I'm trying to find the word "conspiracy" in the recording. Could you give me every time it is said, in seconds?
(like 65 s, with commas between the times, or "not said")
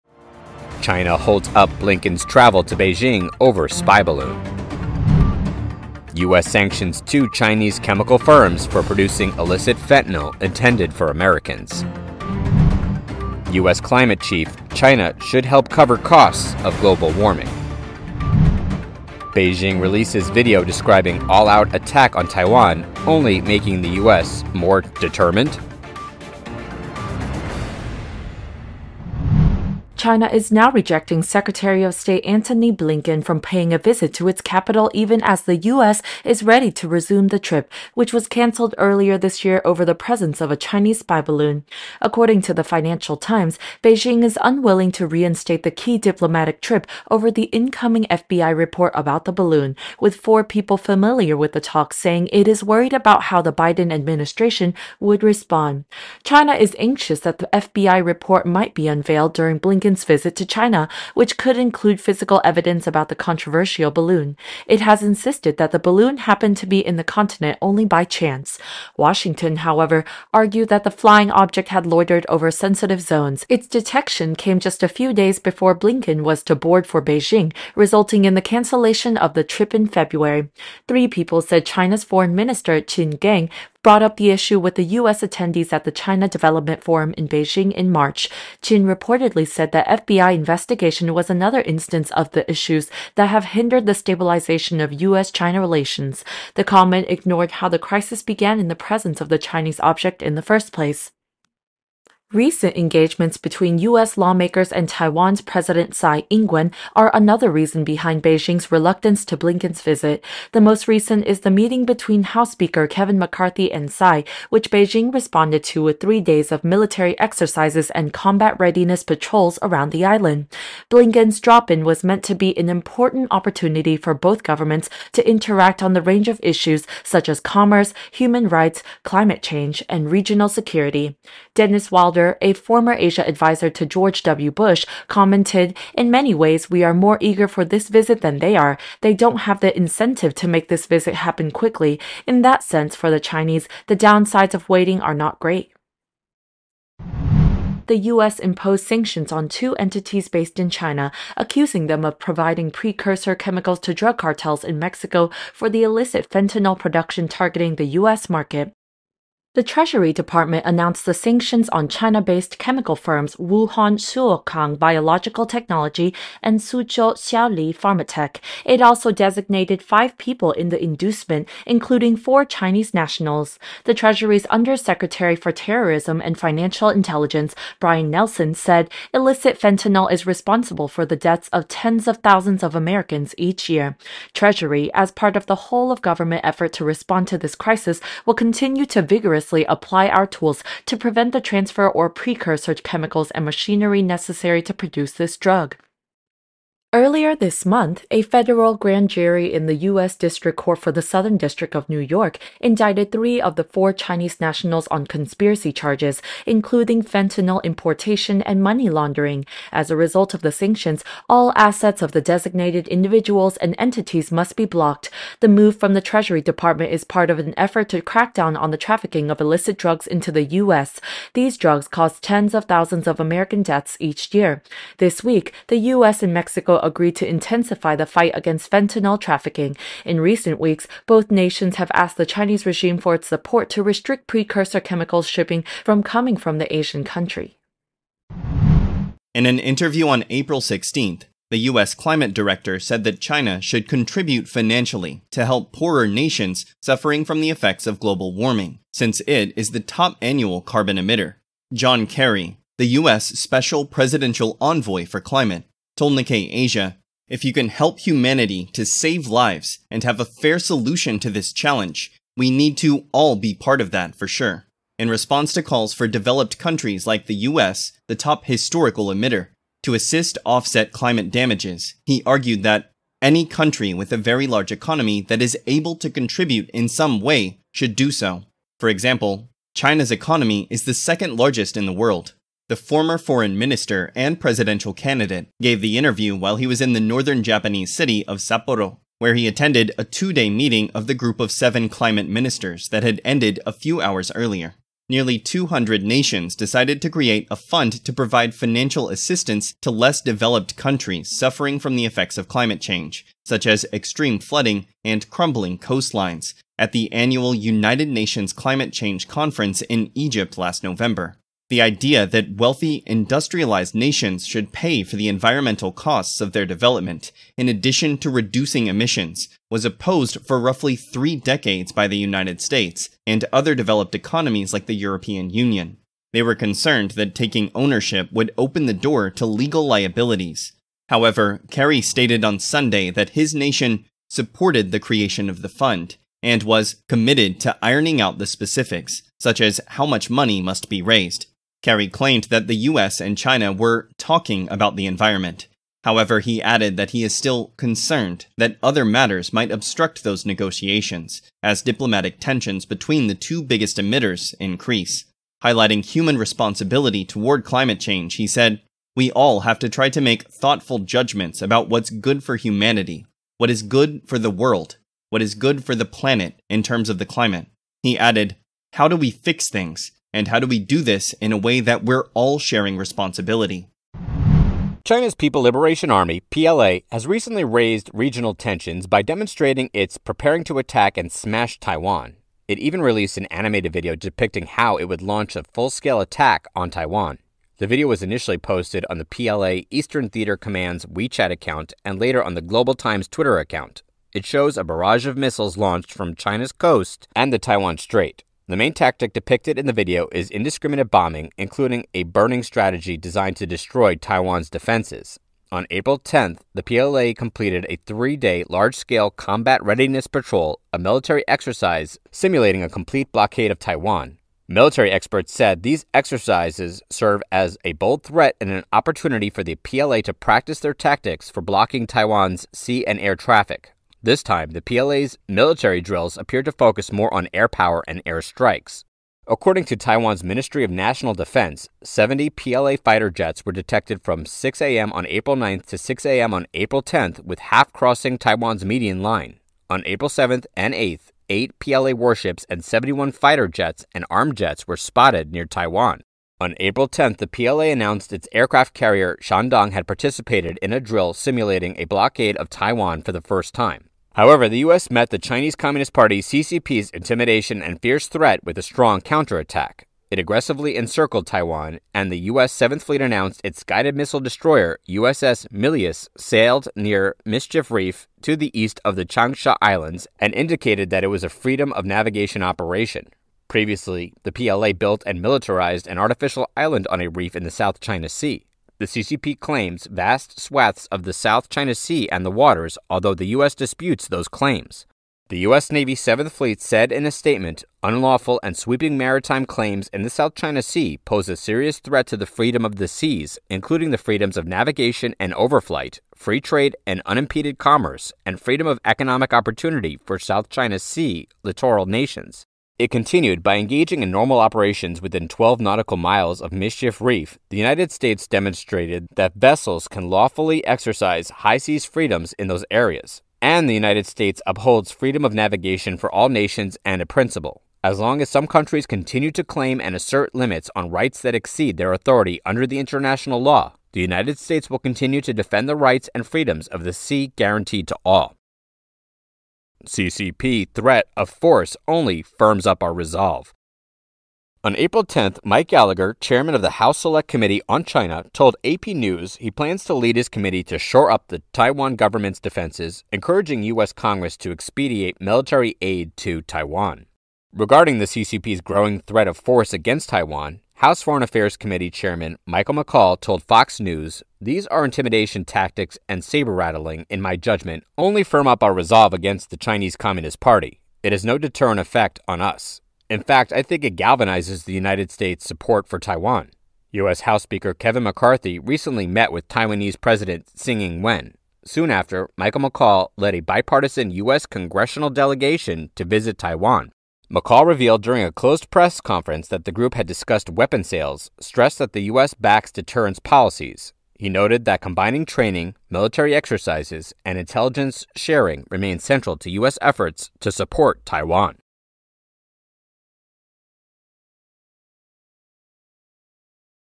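205 s.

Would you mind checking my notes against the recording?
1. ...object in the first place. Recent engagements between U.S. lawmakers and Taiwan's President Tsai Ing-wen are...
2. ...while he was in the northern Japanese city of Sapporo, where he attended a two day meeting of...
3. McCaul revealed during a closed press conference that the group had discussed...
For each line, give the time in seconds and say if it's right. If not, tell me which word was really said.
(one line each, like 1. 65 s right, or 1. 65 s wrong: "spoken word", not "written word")
1. 99 s right
2. 286 s right
3. 577 s right.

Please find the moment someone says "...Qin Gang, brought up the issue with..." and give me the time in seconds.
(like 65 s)
82 s.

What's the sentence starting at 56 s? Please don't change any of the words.
China is anxious that the FBI report might be unveiled during Blinken.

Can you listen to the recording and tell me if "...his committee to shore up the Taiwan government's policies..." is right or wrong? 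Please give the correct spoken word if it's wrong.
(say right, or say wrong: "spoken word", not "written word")
wrong: "defenses", not "policies".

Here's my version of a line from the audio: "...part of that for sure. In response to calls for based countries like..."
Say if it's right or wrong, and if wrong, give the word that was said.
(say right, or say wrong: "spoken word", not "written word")
wrong: "developed", not "based".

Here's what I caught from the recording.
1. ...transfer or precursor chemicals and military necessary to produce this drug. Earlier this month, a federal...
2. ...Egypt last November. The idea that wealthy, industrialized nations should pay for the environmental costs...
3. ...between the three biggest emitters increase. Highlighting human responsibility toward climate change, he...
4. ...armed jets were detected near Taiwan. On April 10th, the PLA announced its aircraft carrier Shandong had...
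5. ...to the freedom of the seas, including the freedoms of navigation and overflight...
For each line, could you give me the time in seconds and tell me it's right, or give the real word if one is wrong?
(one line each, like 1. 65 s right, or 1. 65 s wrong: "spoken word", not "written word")
1. 191 s wrong: "machinery", not "military"
2. 310 s right
3. 352 s wrong: "two", not "three"
4. 444 s wrong: "spotted", not "detected"
5. 492 s right.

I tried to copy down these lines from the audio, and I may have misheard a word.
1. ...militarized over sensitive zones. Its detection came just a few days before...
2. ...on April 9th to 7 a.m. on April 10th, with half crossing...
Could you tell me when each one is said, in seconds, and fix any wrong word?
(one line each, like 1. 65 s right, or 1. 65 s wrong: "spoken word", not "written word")
1. 71 s wrong: "loitered", not "militarized"
2. 435 s wrong: "6", not "7".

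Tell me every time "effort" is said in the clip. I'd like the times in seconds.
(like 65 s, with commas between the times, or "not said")
186 s, 217 s, 590 s.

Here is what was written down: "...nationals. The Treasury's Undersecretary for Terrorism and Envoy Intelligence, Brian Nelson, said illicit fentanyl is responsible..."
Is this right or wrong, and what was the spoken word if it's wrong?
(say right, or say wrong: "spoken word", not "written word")
wrong: "Financial", not "Envoy".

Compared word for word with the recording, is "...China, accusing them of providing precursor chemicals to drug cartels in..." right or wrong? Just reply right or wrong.
right.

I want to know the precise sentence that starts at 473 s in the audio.
Previously, the PLA built and militarized an artificial island on a reef in the South China Sea.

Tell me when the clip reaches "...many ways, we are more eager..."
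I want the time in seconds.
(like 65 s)
136 s.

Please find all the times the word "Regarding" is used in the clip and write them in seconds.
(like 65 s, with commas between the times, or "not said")
547 s.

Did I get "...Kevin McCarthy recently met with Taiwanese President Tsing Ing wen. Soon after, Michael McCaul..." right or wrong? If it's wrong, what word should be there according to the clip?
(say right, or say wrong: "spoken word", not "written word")
right.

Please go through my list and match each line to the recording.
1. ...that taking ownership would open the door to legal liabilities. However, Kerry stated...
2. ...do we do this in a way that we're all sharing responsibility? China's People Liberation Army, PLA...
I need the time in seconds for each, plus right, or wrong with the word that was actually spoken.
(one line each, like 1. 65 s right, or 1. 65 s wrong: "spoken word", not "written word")
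1. 327 s right
2. 370 s right.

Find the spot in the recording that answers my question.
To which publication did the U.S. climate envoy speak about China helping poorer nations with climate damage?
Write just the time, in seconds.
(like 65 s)
256 s.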